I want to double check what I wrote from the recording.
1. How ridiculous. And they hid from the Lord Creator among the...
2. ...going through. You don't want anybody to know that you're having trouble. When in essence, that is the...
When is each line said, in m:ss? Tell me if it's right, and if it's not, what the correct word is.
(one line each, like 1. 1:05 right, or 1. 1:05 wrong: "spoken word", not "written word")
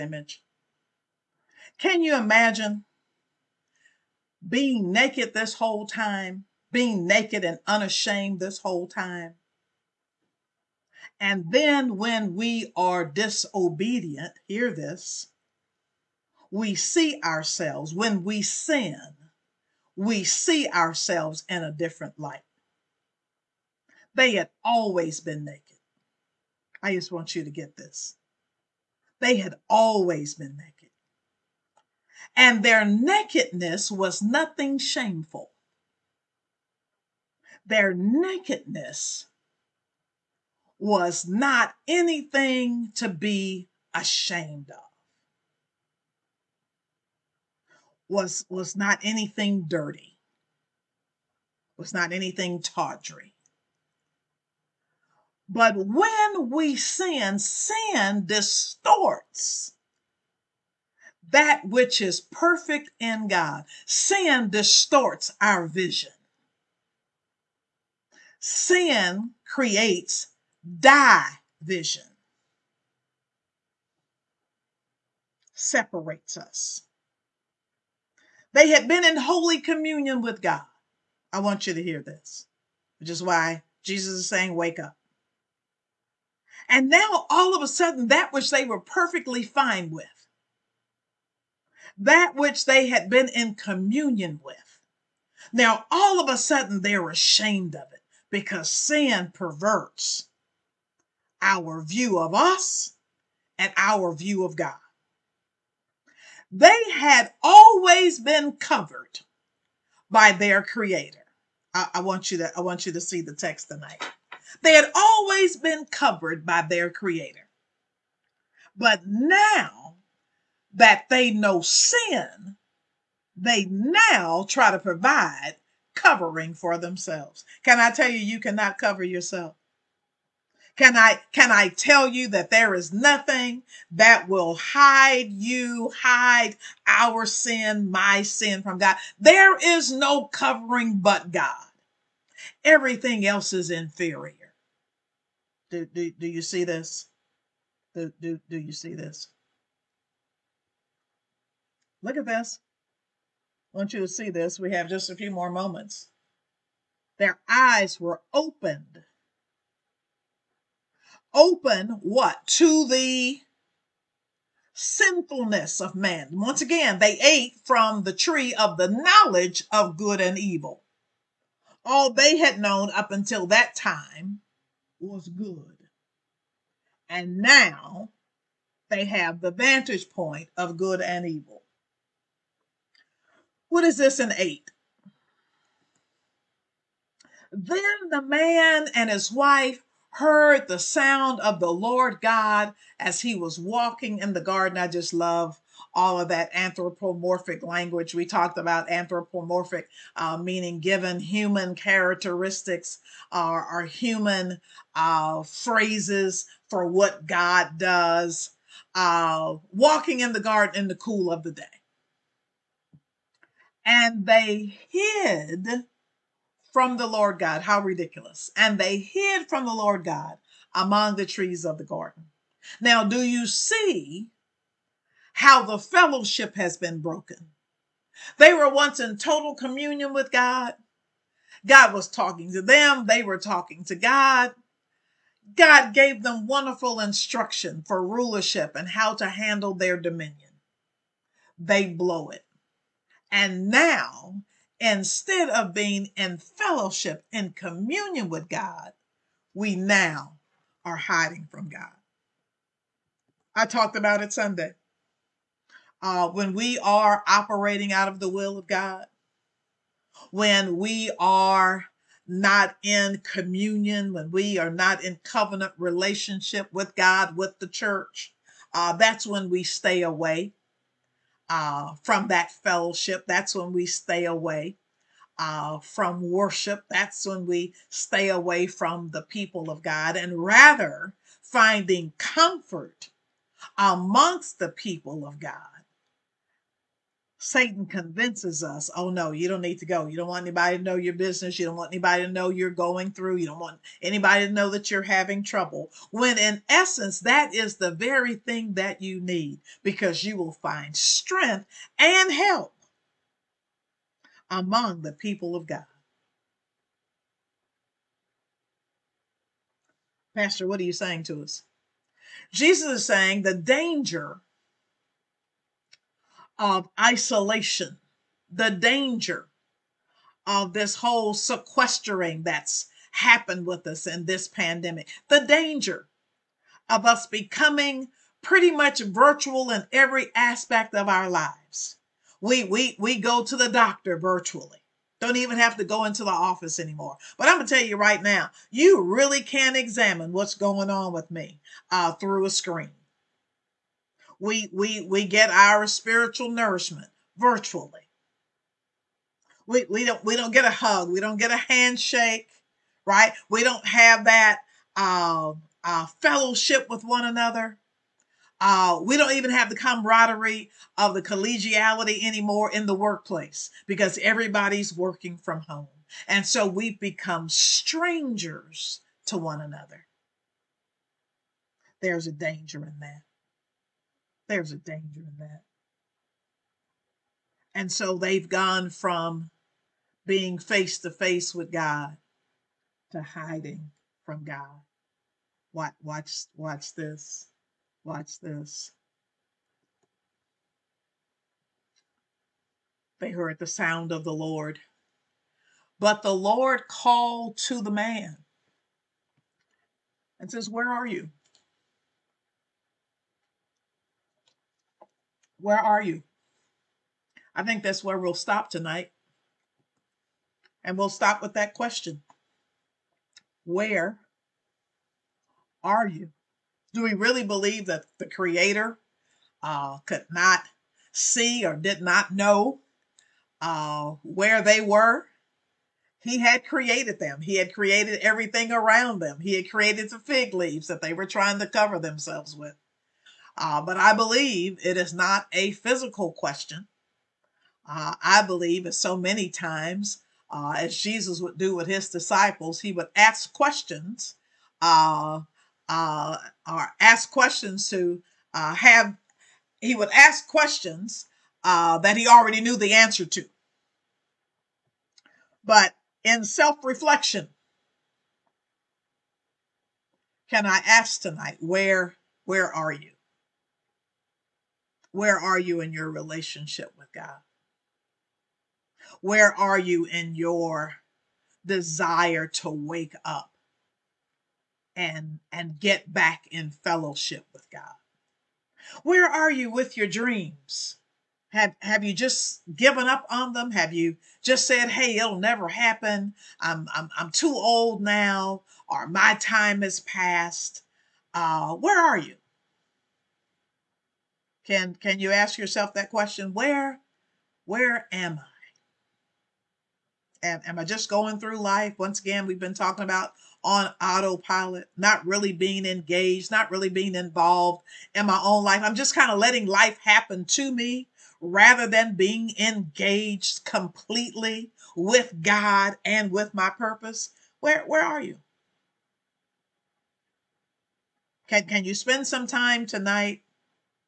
1. 3:37 wrong: "God", not "Creator"
2. 4:52 right.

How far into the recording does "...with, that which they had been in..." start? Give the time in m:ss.
1:29.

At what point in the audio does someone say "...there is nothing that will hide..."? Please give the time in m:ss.
2:12.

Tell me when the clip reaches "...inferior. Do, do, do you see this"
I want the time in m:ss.
2:23.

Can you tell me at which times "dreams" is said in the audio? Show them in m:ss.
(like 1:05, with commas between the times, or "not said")
8:00.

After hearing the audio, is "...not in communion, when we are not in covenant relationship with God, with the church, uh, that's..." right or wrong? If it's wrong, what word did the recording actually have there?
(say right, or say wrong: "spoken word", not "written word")
right.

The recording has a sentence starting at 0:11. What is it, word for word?
And then when we are disobedient, hear this we see ourselves, when we sin, we see ourselves in a different light.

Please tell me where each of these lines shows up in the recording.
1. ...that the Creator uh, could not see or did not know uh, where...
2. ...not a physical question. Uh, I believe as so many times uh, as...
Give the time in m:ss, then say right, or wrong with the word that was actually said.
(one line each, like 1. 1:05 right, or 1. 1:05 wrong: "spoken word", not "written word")
1. 6:57 right
2. 7:15 right.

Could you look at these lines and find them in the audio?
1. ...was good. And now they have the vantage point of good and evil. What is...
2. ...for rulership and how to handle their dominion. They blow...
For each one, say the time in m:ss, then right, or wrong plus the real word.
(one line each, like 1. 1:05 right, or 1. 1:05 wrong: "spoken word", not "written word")
1. 2:54 right
2. 3:57 right.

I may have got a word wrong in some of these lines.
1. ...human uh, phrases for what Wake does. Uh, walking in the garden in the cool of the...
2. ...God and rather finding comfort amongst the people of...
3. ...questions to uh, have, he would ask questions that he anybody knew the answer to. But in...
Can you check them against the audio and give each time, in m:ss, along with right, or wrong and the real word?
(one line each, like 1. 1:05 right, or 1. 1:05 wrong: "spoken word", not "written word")
1. 3:23 wrong: "God", not "Wake"
2. 4:39 right
3. 7:27 wrong: "already", not "anybody".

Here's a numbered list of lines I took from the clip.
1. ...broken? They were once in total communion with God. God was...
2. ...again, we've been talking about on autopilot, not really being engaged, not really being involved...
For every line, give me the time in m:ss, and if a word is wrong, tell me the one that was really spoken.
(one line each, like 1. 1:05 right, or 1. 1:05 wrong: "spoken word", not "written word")
1. 3:46 right
2. 8:22 right.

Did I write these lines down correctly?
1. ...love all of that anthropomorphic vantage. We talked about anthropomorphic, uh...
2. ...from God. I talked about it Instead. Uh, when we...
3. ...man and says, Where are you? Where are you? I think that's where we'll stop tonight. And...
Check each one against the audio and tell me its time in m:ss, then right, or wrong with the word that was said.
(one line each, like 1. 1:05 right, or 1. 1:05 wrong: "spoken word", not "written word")
1. 3:15 wrong: "language", not "vantage"
2. 4:11 wrong: "Sunday", not "Instead"
3. 6:37 right.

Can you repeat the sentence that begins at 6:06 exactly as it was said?
And so we've become strangers to one another.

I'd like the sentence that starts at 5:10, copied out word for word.
Pastor, what are you saying to us?